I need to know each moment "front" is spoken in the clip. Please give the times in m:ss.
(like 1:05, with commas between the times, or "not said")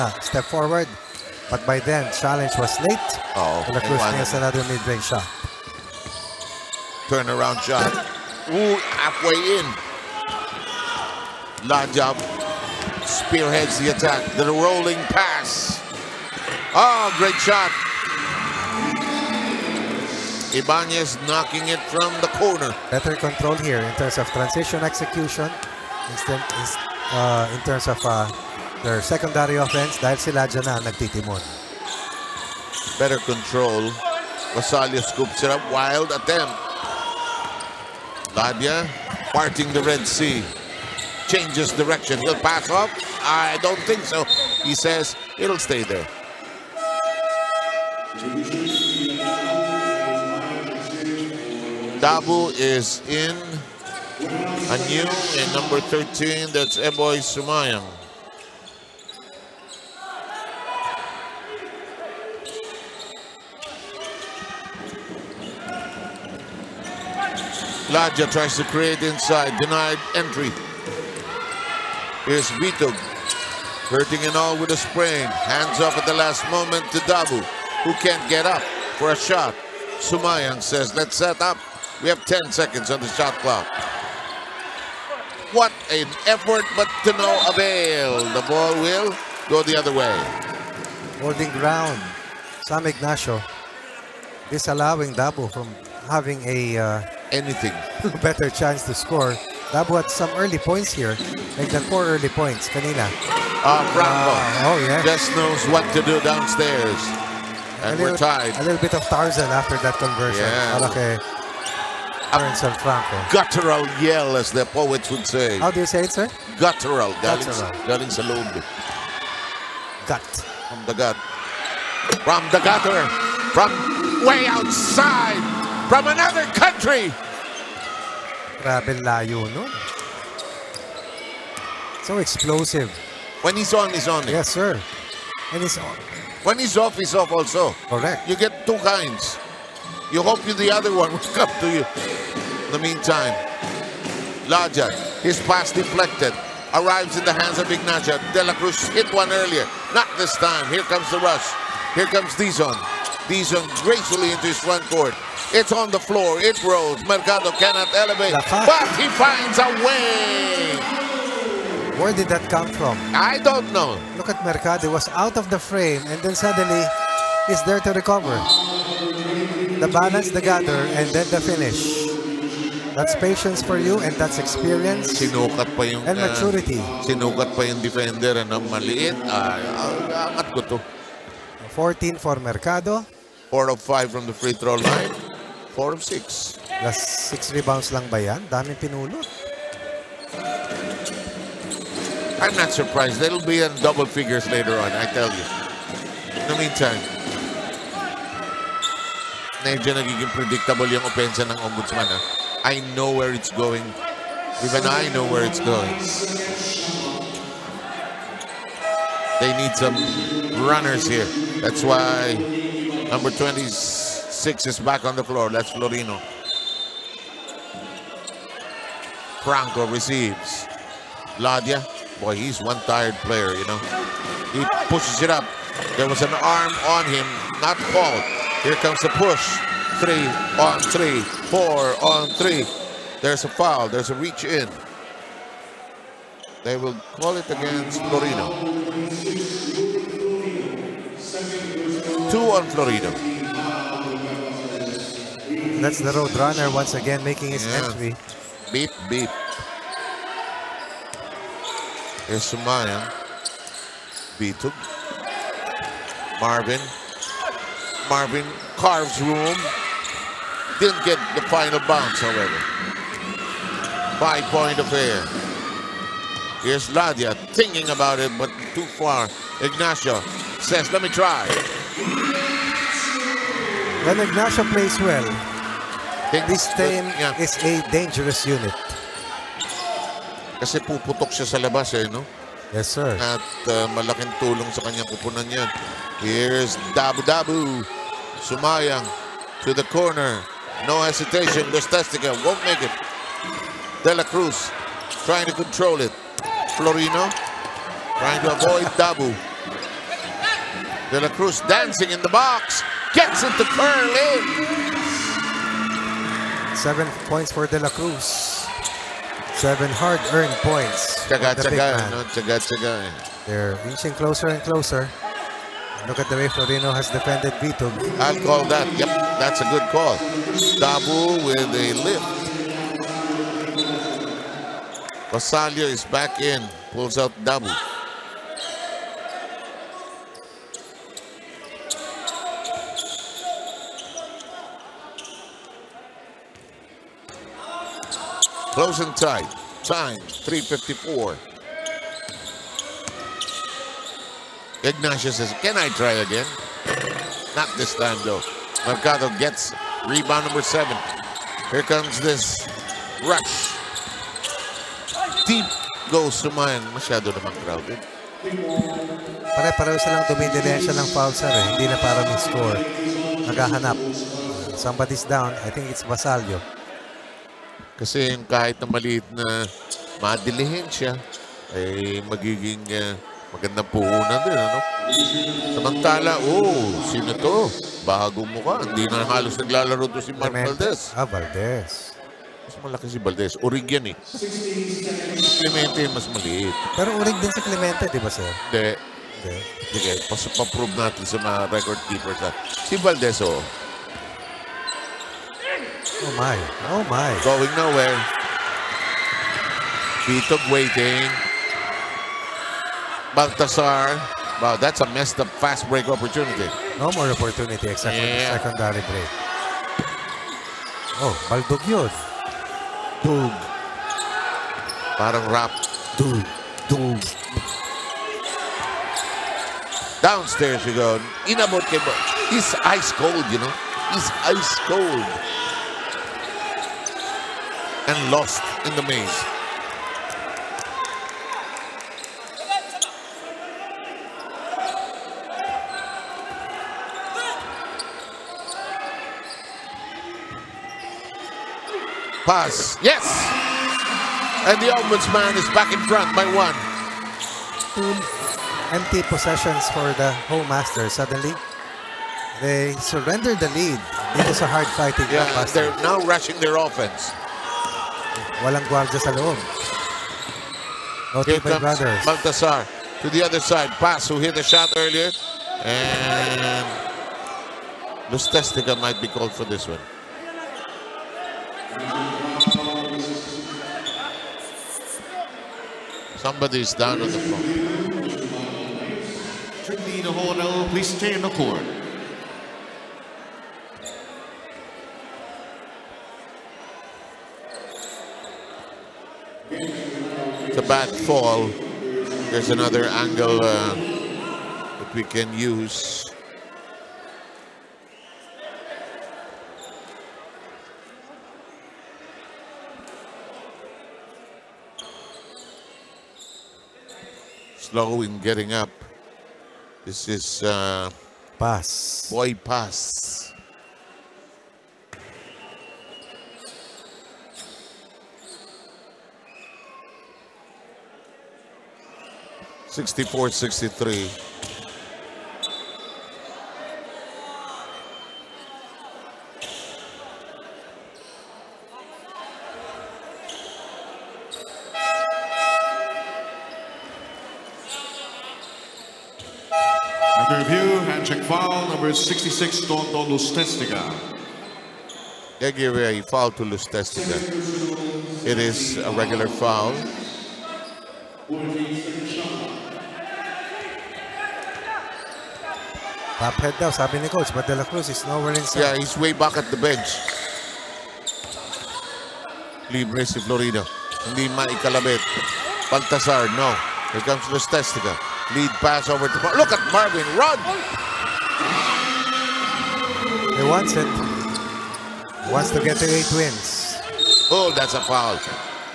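2:34, 7:26.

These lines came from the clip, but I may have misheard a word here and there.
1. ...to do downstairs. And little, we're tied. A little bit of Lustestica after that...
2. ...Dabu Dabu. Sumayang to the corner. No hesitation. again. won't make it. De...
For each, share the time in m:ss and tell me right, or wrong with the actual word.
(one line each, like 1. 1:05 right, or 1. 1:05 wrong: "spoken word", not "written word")
1. 1:45 wrong: "Tarzan", not "Lustestica"
2. 4:46 right.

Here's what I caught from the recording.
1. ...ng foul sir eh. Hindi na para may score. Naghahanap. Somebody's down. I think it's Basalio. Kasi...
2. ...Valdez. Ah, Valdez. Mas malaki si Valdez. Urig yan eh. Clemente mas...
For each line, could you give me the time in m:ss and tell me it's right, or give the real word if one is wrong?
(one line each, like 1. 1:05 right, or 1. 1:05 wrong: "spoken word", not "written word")
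1. 6:00 right
2. 6:20 right.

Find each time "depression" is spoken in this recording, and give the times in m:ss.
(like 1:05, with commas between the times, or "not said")
not said.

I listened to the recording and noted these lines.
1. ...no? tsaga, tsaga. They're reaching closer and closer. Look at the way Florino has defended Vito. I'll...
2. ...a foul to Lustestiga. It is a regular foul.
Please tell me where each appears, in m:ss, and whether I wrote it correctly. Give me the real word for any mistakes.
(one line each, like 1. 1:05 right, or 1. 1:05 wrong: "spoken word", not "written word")
1. 5:12 right
2. 9:05 right.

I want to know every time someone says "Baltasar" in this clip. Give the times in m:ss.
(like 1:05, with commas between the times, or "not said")
6:43, 7:42, 9:25.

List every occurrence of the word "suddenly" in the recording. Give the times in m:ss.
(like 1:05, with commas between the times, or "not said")
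2:46, 7:31.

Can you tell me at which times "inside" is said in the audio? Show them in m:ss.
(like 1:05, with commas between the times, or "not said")
1:09, 9:18.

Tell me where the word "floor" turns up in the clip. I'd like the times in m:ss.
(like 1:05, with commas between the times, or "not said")
2:35, 3:35, 7:57.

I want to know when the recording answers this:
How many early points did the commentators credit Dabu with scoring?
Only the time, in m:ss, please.
1:41.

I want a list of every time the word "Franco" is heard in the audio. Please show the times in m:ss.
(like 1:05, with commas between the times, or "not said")
1:43, 3:39.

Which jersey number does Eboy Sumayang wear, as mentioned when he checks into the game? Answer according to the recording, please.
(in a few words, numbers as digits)
13.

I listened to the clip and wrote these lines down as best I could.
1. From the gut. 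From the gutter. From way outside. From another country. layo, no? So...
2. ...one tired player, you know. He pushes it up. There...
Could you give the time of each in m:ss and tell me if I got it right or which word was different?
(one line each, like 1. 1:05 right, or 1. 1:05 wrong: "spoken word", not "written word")
1. 2:00 right
2. 3:42 right.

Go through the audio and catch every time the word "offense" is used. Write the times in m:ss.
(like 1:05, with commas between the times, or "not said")
0:29, 7:36.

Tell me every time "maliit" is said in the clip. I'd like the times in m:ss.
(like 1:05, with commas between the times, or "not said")
2:58, 6:08, 6:26.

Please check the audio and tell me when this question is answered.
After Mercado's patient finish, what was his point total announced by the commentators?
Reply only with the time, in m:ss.
3:01.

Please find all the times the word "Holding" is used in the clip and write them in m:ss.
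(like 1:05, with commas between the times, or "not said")
1:31.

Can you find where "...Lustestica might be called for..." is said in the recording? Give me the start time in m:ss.
7:48.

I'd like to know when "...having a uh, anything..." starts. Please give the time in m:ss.
1:36.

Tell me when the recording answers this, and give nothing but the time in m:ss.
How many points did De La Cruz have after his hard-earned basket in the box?
5:06.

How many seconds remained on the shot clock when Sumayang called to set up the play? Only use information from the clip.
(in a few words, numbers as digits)
10.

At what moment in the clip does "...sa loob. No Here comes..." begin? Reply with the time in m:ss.
7:39.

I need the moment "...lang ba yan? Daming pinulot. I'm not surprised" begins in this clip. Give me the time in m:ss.
3:07.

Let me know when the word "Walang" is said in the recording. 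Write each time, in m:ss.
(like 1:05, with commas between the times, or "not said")
7:38.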